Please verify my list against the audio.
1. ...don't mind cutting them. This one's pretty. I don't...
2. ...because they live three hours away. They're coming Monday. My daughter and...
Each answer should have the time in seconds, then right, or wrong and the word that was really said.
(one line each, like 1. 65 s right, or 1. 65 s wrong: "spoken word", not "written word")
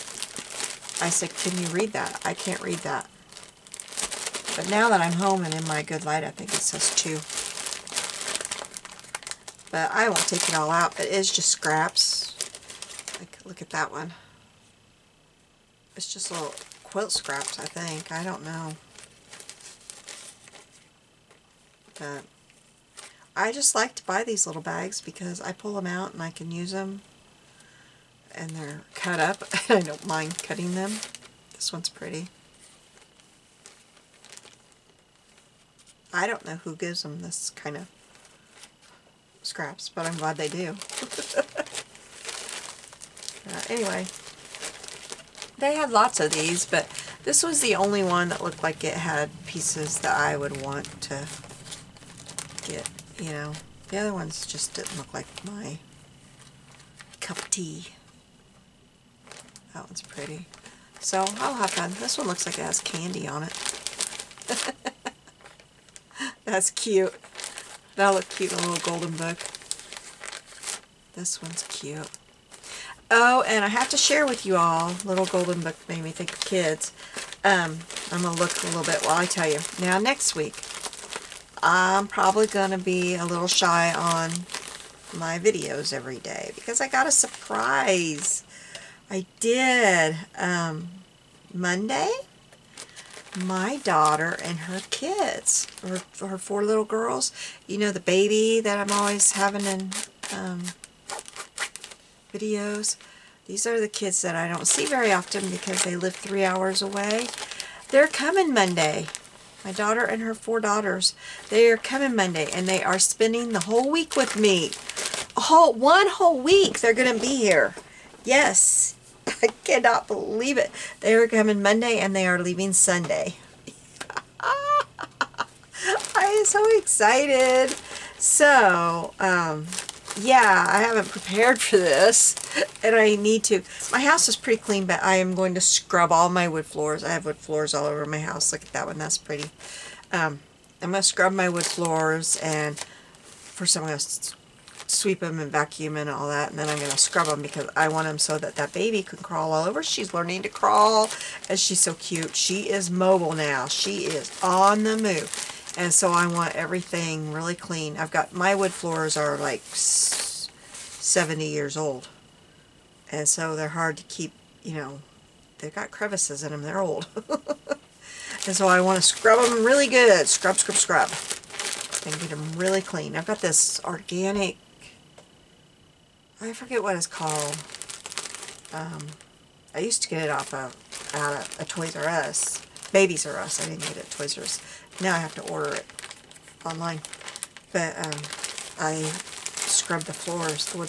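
1. 29 s right
2. 105 s right.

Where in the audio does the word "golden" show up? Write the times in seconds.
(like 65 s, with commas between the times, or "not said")
68 s, 75 s.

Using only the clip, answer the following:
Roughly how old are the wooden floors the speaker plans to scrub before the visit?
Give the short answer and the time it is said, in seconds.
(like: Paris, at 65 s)
70 years, at 159 s.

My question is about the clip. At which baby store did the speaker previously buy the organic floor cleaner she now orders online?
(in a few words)
Babies R Us.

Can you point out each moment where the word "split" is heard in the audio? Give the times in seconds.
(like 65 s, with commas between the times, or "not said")
not said.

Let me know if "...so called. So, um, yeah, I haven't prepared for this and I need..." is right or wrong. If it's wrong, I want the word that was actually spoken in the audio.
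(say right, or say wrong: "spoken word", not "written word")
wrong: "excited", not "called".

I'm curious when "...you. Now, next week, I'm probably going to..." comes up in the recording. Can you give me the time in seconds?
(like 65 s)
79 s.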